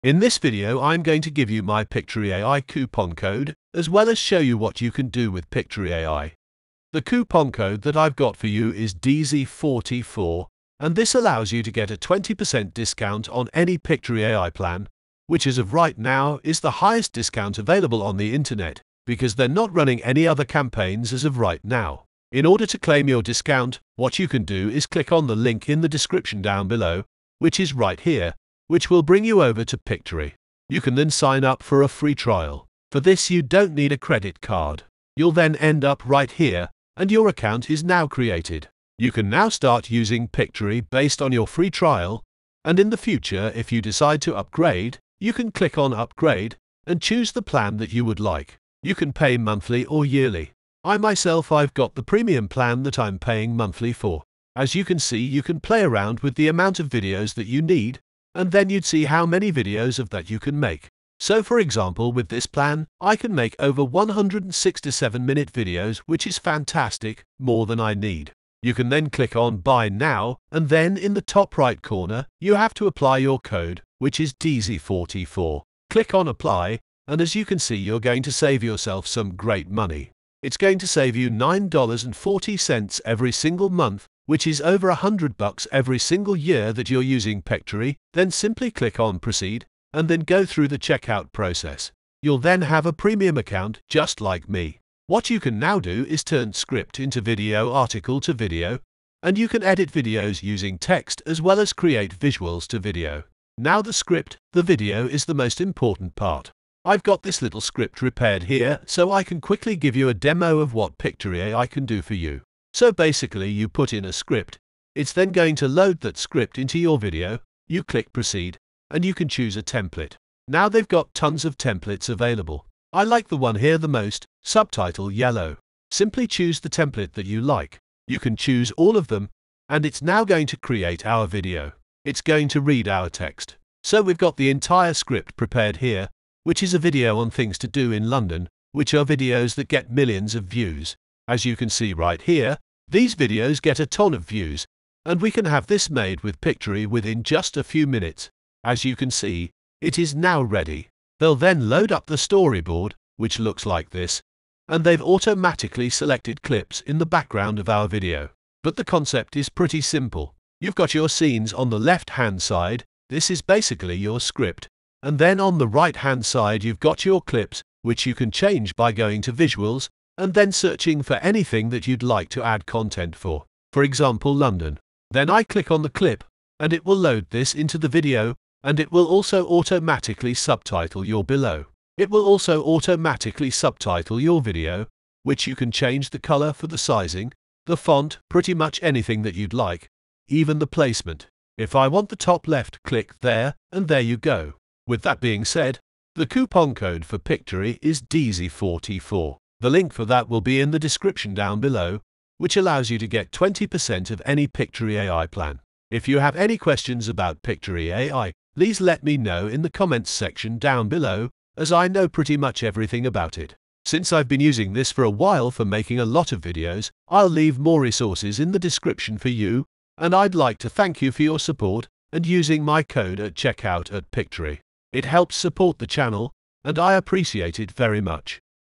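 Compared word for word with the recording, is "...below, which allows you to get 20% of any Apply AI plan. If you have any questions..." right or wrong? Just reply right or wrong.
wrong.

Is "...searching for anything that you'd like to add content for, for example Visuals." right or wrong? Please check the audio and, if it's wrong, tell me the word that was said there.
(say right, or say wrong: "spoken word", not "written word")
wrong: "London", not "Visuals".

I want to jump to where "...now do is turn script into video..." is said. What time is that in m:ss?
1:35.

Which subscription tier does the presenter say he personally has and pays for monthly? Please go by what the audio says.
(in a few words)
premium plan.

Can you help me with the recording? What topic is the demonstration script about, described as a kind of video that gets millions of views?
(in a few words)
things to do in London.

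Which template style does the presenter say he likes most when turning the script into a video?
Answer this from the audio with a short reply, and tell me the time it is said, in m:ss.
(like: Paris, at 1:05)
subtitle yellow, at 2:04.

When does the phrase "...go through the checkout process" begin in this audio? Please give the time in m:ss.
1:30.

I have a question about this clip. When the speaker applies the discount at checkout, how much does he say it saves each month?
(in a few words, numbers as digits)
$9.40.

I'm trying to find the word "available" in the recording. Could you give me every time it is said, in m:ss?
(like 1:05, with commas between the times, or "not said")
0:17, 2:02.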